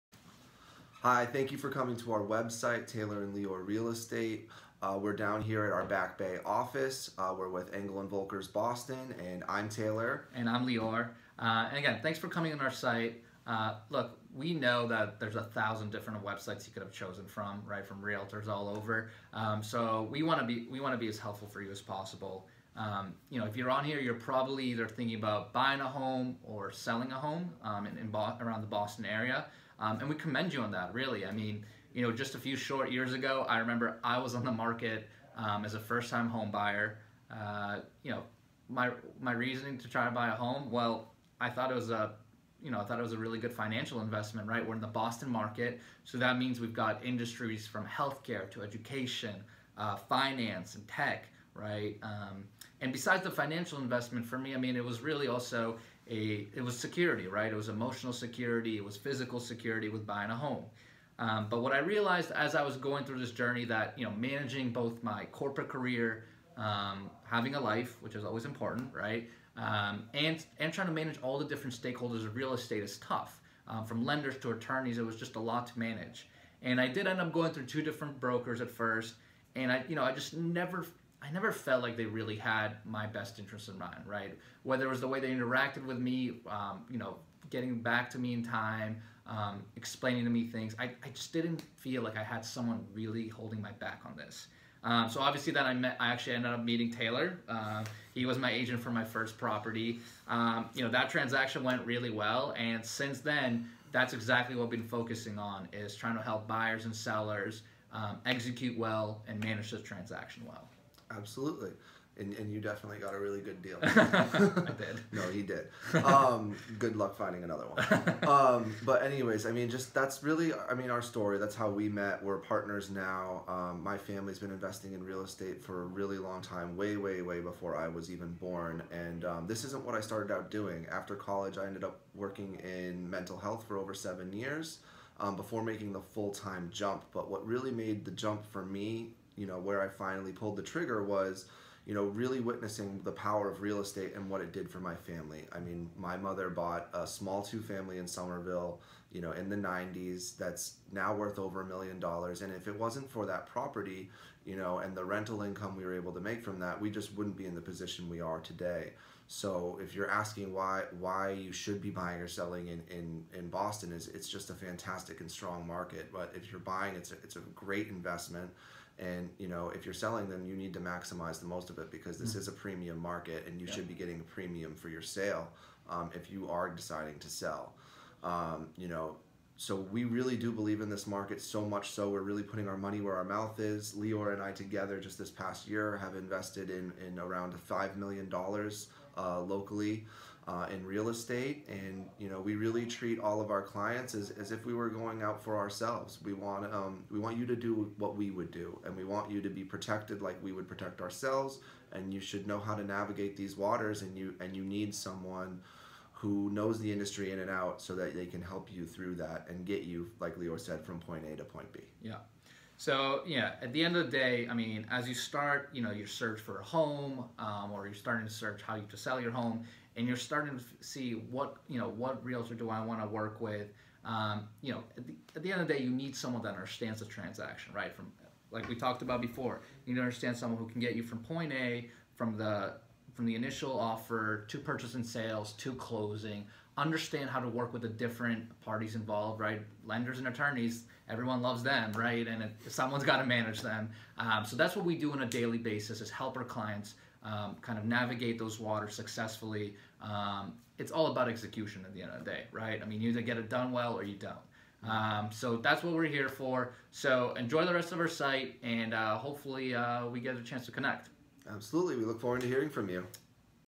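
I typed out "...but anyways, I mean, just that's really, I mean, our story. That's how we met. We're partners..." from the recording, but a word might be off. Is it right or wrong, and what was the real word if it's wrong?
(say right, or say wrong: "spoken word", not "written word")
right.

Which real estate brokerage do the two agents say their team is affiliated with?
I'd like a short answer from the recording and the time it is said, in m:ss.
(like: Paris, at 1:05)
Engel and Volkers Boston, at 0:07.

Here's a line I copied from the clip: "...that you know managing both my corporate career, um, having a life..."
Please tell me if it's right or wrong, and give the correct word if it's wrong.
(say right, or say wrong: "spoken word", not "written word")
right.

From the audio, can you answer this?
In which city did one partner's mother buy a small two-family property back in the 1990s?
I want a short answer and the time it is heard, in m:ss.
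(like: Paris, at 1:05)
Somerville, at 2:28.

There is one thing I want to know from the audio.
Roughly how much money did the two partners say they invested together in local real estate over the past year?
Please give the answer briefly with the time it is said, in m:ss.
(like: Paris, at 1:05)
$5 million, at 3:07.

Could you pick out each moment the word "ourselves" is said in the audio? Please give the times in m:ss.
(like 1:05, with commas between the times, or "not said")
3:15, 3:21.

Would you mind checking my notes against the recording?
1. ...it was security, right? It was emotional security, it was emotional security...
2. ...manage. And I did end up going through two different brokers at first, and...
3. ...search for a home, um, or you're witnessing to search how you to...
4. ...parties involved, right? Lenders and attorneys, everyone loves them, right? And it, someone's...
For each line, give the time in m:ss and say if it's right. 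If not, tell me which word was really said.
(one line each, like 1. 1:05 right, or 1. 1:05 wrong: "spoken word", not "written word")
1. 0:56 wrong: "physical", not "emotional"
2. 1:15 right
3. 3:36 wrong: "starting", not "witnessing"
4. 3:58 right.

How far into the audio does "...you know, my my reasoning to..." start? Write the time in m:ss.
0:38.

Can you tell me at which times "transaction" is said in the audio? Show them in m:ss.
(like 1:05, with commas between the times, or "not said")
1:41, 1:49, 3:47.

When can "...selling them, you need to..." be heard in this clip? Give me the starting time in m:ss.
2:49.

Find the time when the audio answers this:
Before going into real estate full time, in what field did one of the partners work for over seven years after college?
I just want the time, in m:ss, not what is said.
2:13.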